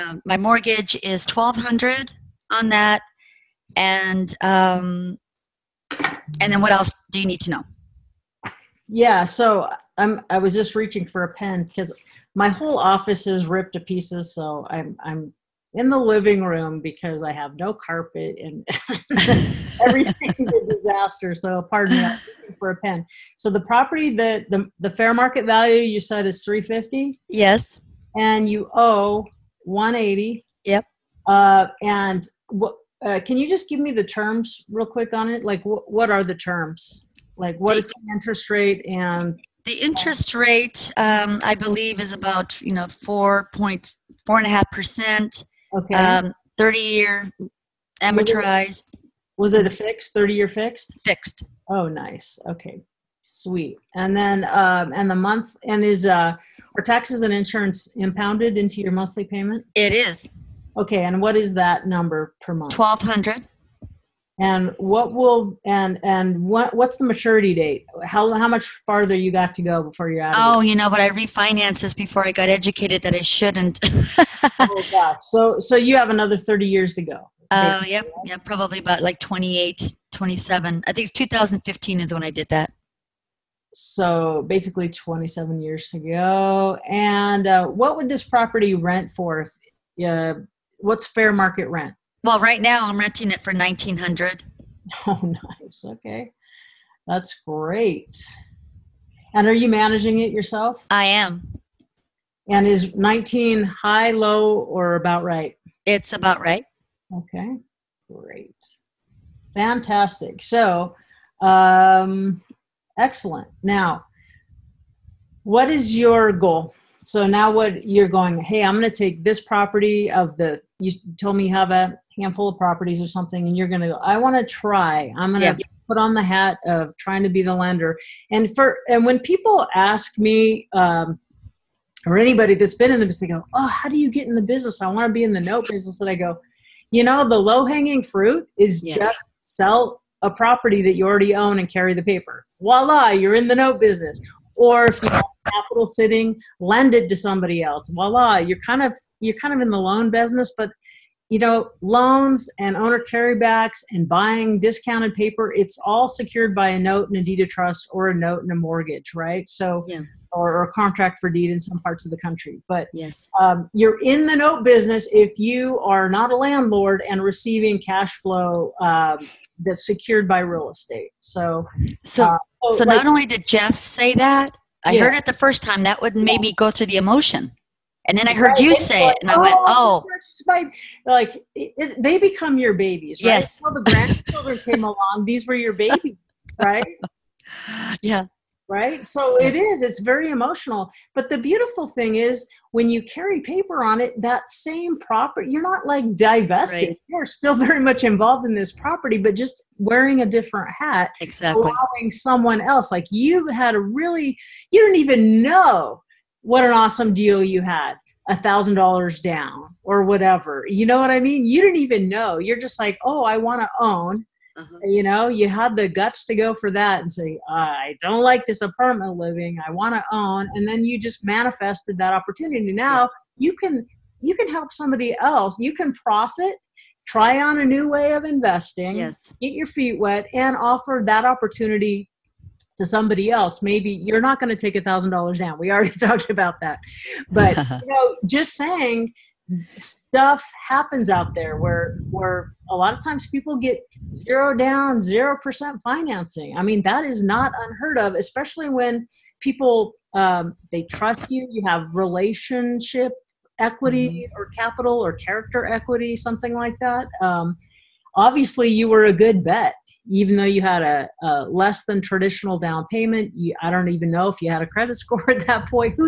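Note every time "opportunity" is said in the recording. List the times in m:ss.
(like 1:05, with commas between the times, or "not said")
3:42, 3:51.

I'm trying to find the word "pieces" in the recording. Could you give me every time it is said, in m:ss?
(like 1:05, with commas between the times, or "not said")
0:13.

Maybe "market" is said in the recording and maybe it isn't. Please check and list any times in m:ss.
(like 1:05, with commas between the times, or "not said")
0:25, 1:31.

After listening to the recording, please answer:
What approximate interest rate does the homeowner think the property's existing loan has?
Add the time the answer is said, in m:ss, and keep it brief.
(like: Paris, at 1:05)
4.5%, at 0:42.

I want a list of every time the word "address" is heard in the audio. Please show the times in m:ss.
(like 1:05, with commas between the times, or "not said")
not said.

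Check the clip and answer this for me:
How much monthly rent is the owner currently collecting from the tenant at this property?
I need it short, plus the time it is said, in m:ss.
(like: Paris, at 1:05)
1900, at 1:33.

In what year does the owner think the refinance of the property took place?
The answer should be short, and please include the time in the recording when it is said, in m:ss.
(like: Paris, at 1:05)
2015, at 1:21.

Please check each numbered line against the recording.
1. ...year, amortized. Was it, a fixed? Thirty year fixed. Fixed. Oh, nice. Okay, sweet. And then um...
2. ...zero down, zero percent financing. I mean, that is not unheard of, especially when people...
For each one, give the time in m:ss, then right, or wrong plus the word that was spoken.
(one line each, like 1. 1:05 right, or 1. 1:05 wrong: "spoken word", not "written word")
1. 0:46 right
2. 4:04 right.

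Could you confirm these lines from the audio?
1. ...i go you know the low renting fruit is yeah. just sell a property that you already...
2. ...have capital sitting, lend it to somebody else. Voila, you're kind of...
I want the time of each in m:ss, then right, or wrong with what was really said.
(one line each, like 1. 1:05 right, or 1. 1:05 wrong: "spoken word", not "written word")
1. 2:16 wrong: "hanging", not "renting"
2. 2:25 right.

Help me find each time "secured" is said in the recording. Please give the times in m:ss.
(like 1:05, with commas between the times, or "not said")
2:36, 2:49.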